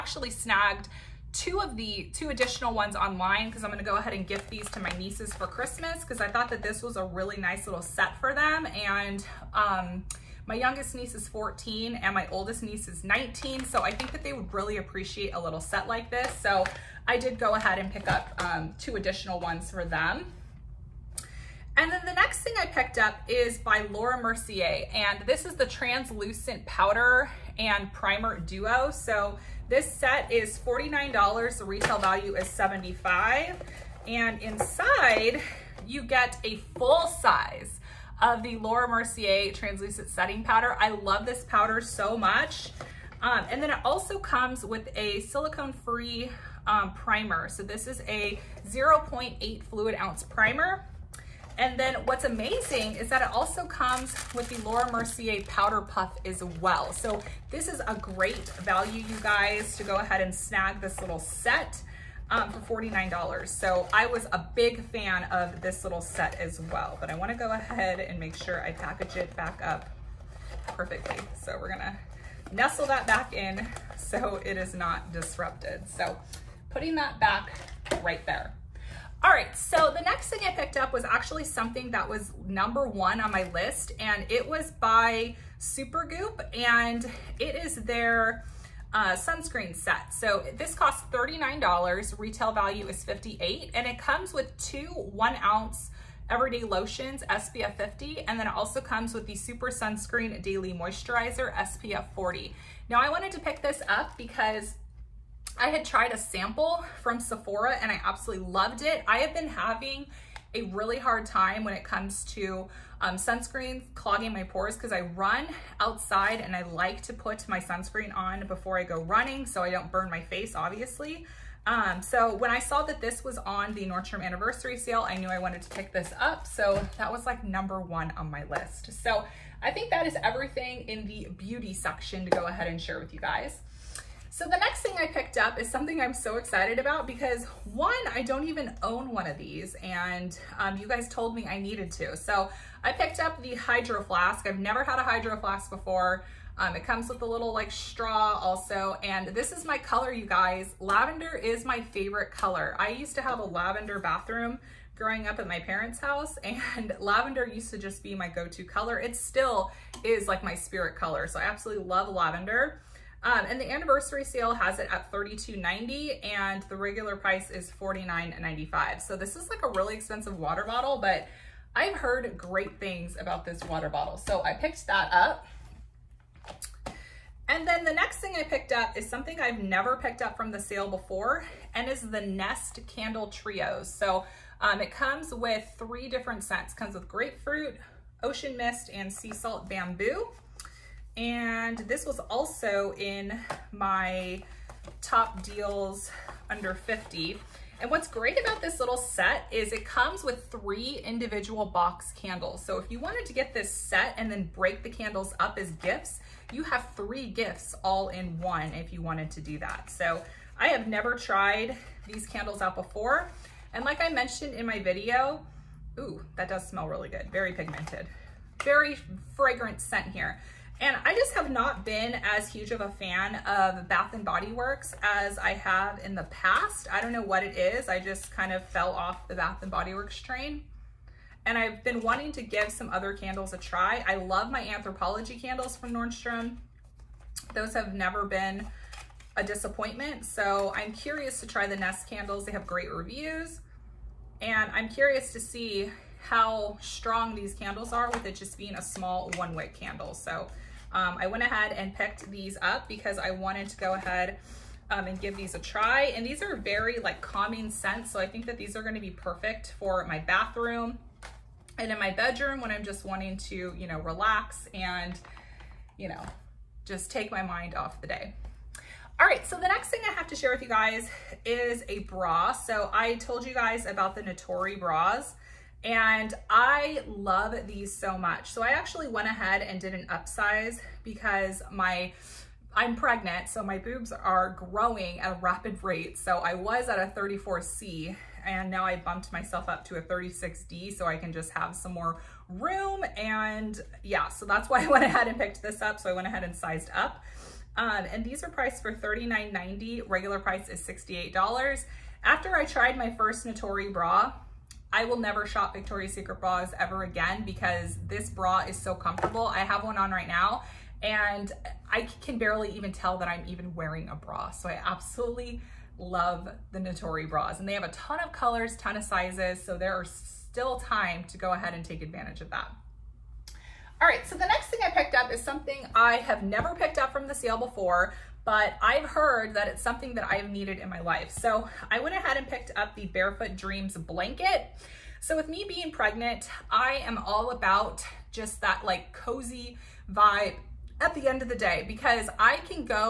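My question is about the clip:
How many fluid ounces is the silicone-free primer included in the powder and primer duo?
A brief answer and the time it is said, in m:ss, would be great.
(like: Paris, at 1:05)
0.8, at 0:48.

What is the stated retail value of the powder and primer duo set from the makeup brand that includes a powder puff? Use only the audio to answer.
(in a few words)
$75.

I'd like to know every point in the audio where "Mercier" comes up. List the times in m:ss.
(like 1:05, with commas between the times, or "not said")
0:24, 0:38, 0:54.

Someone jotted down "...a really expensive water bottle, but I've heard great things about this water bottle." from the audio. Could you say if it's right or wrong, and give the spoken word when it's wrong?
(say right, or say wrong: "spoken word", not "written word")
right.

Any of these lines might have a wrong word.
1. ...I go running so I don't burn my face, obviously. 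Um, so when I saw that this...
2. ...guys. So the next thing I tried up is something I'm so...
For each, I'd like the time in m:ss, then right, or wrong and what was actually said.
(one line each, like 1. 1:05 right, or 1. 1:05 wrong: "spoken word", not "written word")
1. 1:58 right
2. 2:13 wrong: "picked", not "tried".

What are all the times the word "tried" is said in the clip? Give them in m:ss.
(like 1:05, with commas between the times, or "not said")
1:45, 3:31, 5:02.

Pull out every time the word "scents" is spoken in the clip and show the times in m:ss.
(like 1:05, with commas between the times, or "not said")
3:06, 3:39, 4:17.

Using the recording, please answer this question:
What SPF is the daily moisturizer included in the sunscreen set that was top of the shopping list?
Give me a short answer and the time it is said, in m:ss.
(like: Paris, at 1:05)
SPF 40, at 1:41.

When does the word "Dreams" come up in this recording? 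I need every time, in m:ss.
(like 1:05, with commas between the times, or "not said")
5:33.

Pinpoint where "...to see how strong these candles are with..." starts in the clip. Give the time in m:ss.
4:05.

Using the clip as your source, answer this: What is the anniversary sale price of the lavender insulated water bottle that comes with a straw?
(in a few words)
$32.90.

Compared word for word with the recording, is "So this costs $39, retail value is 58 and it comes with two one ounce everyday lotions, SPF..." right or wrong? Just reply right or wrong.
right.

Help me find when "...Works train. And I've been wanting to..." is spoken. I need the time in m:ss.
3:49.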